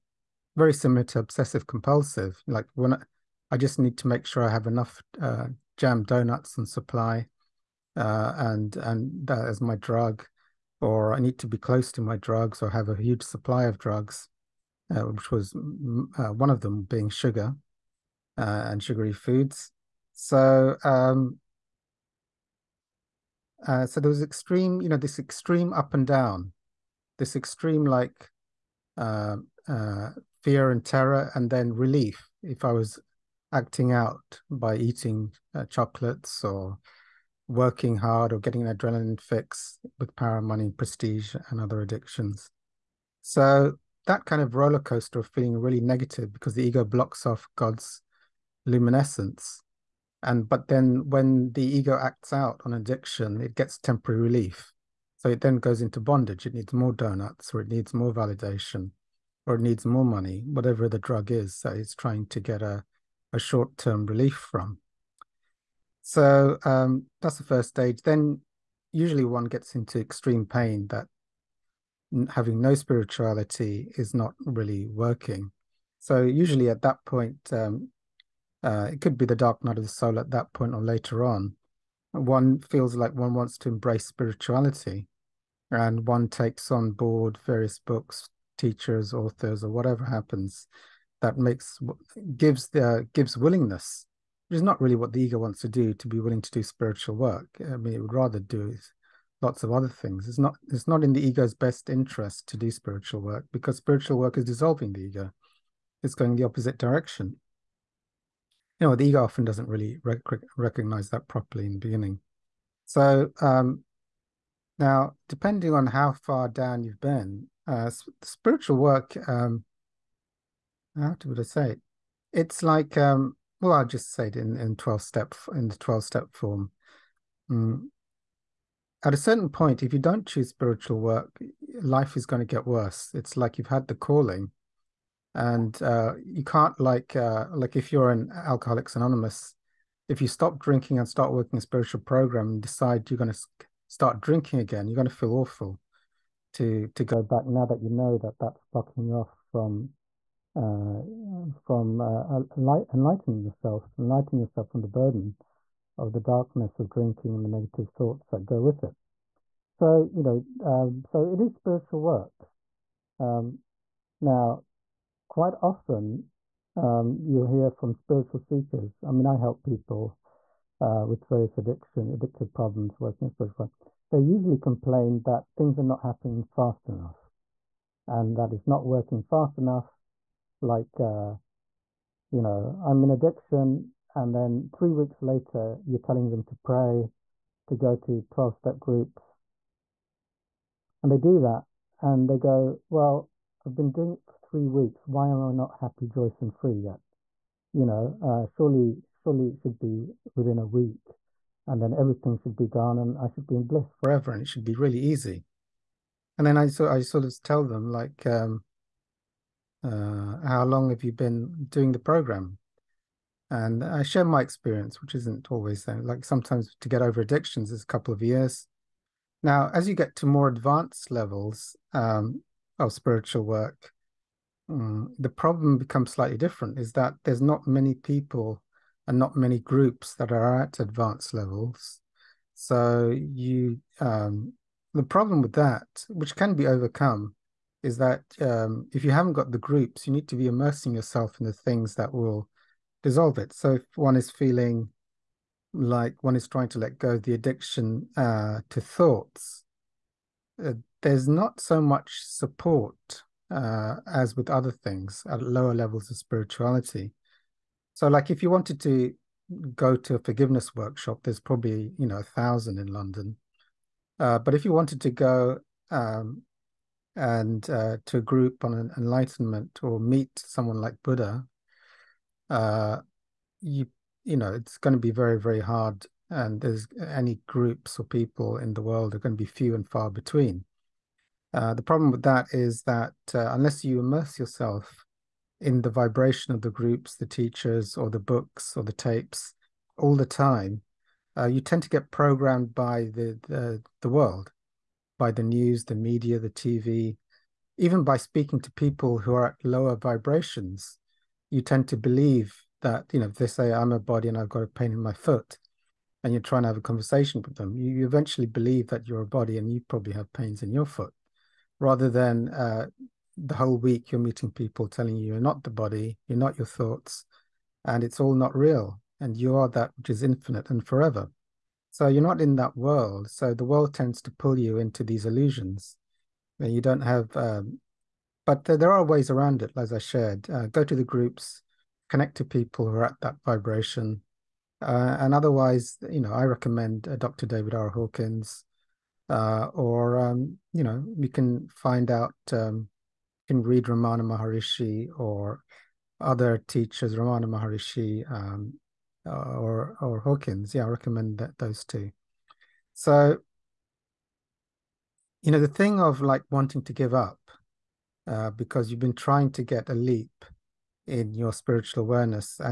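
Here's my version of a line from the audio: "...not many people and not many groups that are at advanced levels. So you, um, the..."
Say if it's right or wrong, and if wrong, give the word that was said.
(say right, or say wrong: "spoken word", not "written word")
right.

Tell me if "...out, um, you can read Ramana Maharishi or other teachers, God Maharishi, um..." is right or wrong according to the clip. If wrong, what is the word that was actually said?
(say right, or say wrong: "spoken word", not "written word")
wrong: "Ramana", not "God".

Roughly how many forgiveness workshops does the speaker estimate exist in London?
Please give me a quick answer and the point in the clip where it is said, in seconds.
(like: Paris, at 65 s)
1000, at 262 s.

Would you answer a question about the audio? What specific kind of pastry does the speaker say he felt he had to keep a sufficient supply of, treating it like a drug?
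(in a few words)
Jam donuts.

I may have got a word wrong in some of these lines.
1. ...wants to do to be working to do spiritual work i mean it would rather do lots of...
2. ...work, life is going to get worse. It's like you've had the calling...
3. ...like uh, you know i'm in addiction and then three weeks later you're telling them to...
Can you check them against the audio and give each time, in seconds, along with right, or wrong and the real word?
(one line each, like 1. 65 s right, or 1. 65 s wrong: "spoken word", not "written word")
1. 95 s wrong: "willing", not "working"
2. 130 s right
3. 180 s right.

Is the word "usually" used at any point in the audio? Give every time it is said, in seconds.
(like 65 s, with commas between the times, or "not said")
68 s, 76 s, 174 s.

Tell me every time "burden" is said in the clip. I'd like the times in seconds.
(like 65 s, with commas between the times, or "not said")
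154 s.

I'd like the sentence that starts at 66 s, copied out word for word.
So um, that's the first stage.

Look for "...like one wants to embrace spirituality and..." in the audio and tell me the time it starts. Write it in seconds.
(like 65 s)
82 s.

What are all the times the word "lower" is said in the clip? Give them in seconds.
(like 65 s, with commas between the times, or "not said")
255 s, 299 s.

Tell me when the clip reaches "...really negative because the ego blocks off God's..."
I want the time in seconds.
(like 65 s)
45 s.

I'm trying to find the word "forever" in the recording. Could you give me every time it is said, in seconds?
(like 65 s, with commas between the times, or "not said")
203 s, 320 s.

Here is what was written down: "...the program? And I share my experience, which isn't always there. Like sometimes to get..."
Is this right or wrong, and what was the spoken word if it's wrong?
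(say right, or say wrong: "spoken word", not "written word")
right.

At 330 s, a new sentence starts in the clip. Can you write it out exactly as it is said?
Uh, go to the groups, connect to people who are at that vibration.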